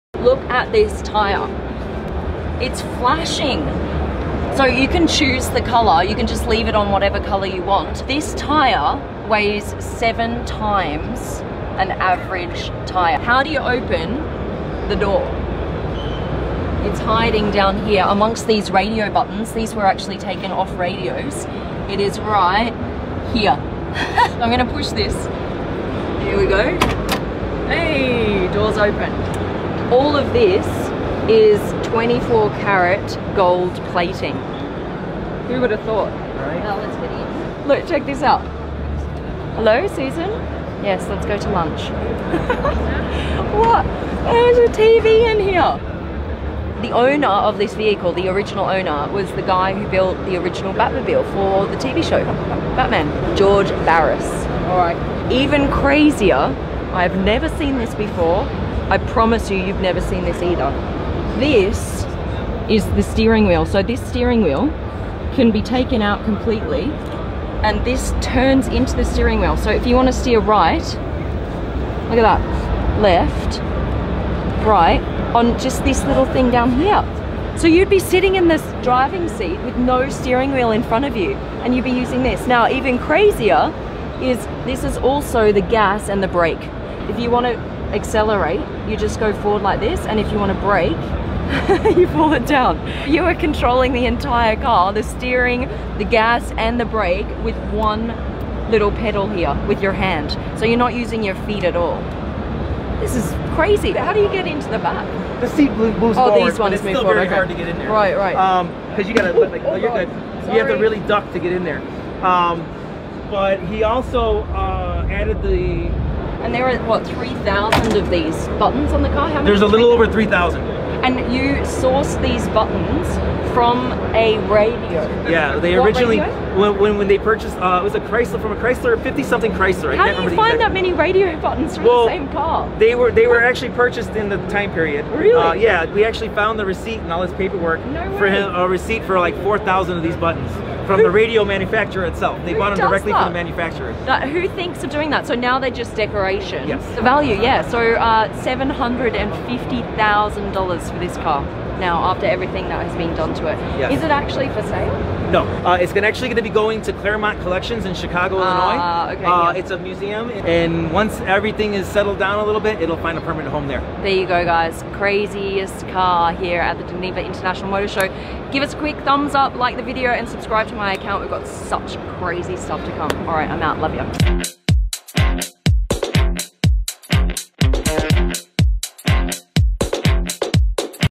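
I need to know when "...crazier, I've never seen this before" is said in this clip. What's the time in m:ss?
0:55.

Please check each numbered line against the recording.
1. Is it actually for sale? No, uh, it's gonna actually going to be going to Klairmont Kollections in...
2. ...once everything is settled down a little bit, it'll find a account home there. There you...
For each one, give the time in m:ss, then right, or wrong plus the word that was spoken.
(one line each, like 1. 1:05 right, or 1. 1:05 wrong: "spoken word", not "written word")
1. 2:33 right
2. 2:40 wrong: "permanent", not "account".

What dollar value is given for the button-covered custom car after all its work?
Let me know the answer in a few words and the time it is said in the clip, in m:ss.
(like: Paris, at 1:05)
$750,000, at 2:28.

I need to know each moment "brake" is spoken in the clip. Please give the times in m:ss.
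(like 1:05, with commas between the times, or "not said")
1:26, 1:30, 1:36.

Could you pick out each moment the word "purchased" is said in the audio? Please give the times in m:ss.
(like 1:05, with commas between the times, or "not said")
2:07, 2:13.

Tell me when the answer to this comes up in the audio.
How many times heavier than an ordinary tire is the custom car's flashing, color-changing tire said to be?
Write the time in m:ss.
0:09.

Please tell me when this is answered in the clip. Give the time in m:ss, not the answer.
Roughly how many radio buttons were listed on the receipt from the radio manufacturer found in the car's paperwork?
2:19.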